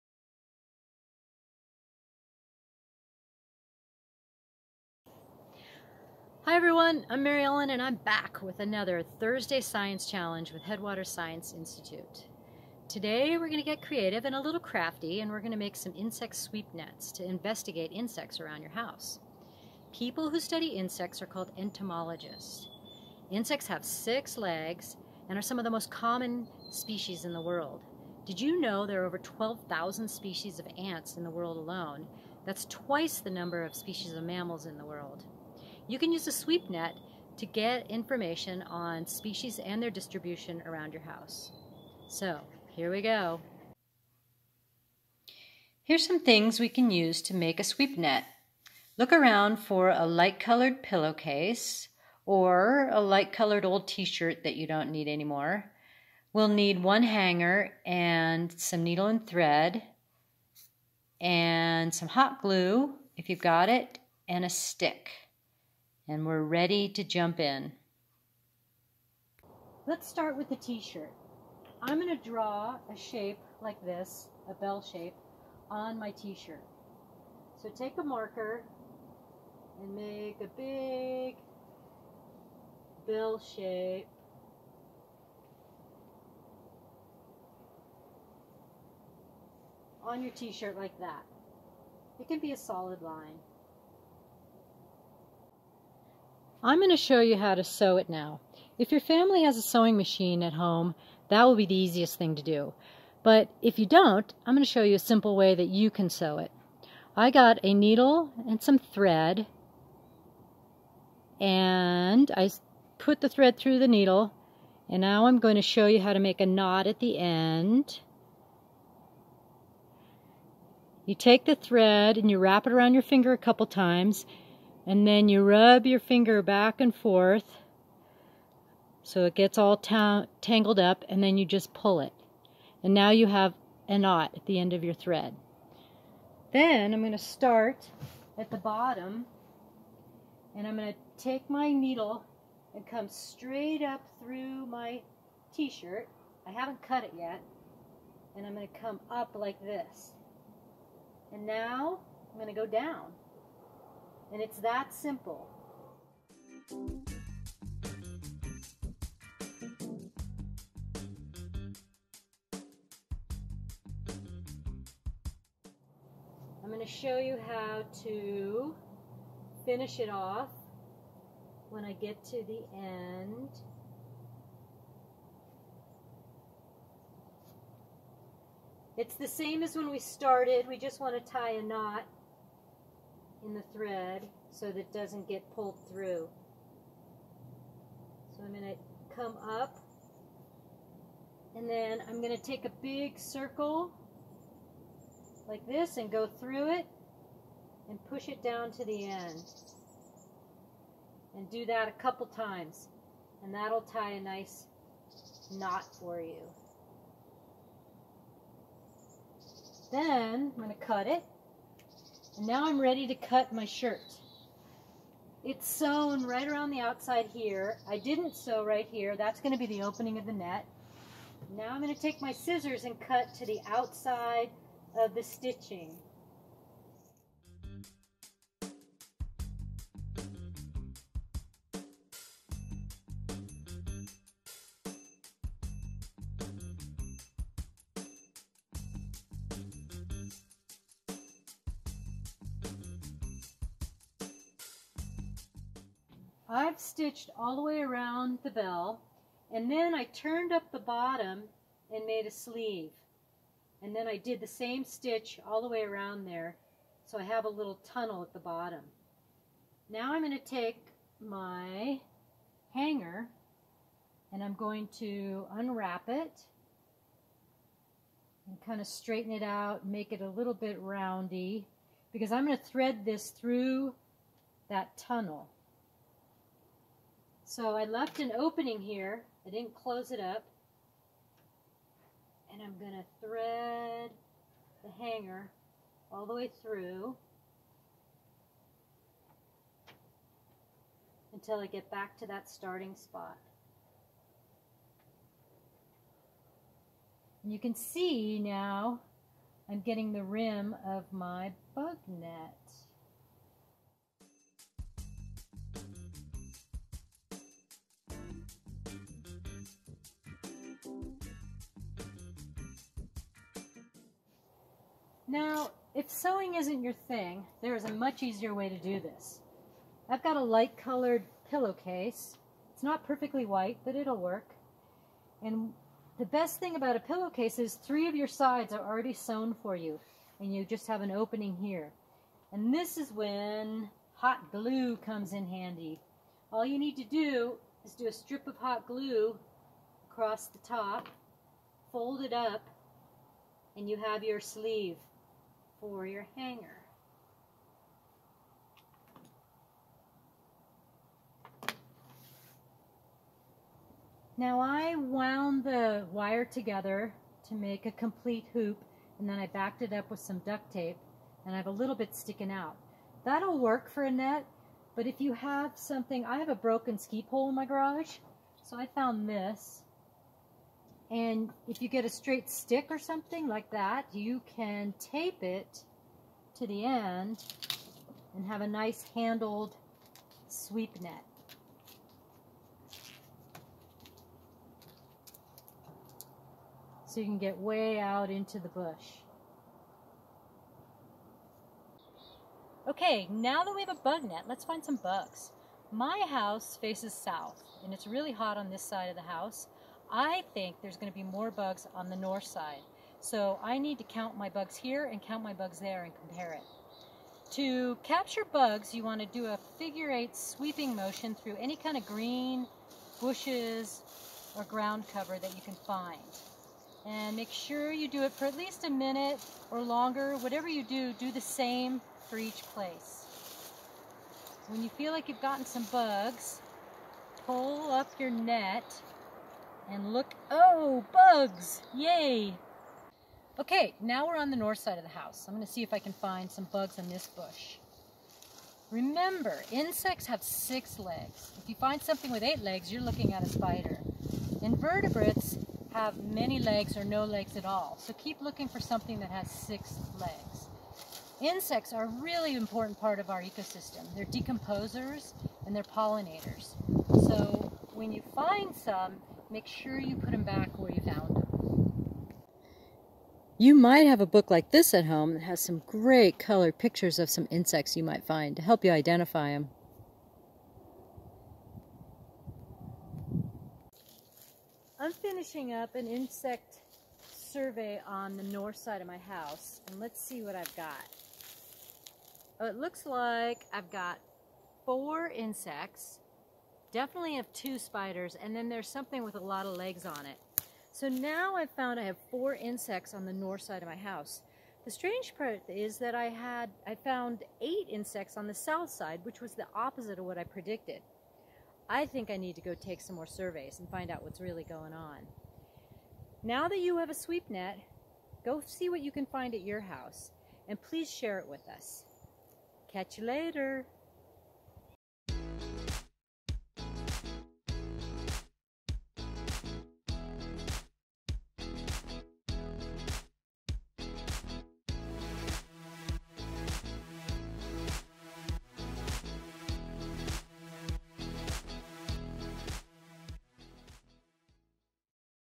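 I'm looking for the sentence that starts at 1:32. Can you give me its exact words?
It can be a solid line.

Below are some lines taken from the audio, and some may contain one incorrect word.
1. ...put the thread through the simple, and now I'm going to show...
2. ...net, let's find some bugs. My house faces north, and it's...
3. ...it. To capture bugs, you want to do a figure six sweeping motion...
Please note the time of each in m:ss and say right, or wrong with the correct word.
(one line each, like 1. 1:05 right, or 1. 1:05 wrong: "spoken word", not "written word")
1. 1:52 wrong: "needle", not "simple"
2. 6:34 wrong: "south", not "north"
3. 6:46 wrong: "eight", not "six".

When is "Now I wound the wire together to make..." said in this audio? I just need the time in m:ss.
5:54.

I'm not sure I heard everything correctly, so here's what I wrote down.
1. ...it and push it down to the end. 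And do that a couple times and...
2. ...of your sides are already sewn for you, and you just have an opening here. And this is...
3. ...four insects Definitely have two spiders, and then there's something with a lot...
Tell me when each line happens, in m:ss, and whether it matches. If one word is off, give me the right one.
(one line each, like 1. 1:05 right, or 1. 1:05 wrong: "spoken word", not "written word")
1. 3:16 right
2. 5:28 right
3. 8:04 right.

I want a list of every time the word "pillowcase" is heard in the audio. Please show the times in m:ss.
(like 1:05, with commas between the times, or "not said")
0:50, 5:21, 5:26.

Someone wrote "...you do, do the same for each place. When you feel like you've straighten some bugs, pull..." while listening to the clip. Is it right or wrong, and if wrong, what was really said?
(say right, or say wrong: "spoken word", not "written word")
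wrong: "gotten", not "straighten".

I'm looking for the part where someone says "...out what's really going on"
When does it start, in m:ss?
8:24.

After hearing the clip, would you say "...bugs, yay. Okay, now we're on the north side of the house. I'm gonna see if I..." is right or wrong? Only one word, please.
right.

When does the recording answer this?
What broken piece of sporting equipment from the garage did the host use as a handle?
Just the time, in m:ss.
6:06.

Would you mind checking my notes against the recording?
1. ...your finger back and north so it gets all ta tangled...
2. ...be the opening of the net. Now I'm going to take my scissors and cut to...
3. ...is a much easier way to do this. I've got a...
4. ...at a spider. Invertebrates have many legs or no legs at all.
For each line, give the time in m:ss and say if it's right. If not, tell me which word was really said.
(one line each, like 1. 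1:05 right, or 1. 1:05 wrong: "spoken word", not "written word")
1. 2:05 wrong: "forth", not "north"
2. 3:39 right
3. 5:17 right
4. 7:23 right.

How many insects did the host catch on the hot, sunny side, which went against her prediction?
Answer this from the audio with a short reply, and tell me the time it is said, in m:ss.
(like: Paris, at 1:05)
8, at 8:17.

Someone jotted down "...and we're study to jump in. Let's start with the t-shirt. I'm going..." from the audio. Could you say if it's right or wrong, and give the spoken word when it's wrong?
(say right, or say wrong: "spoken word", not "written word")
wrong: "ready", not "study".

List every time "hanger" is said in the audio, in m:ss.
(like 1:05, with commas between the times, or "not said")
0:57, 4:22, 4:45, 5:46.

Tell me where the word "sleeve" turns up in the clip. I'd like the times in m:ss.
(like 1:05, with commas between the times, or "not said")
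4:12, 5:44.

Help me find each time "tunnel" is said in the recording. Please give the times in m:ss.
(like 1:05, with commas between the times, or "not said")
4:17, 4:34.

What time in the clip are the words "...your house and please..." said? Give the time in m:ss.
8:29.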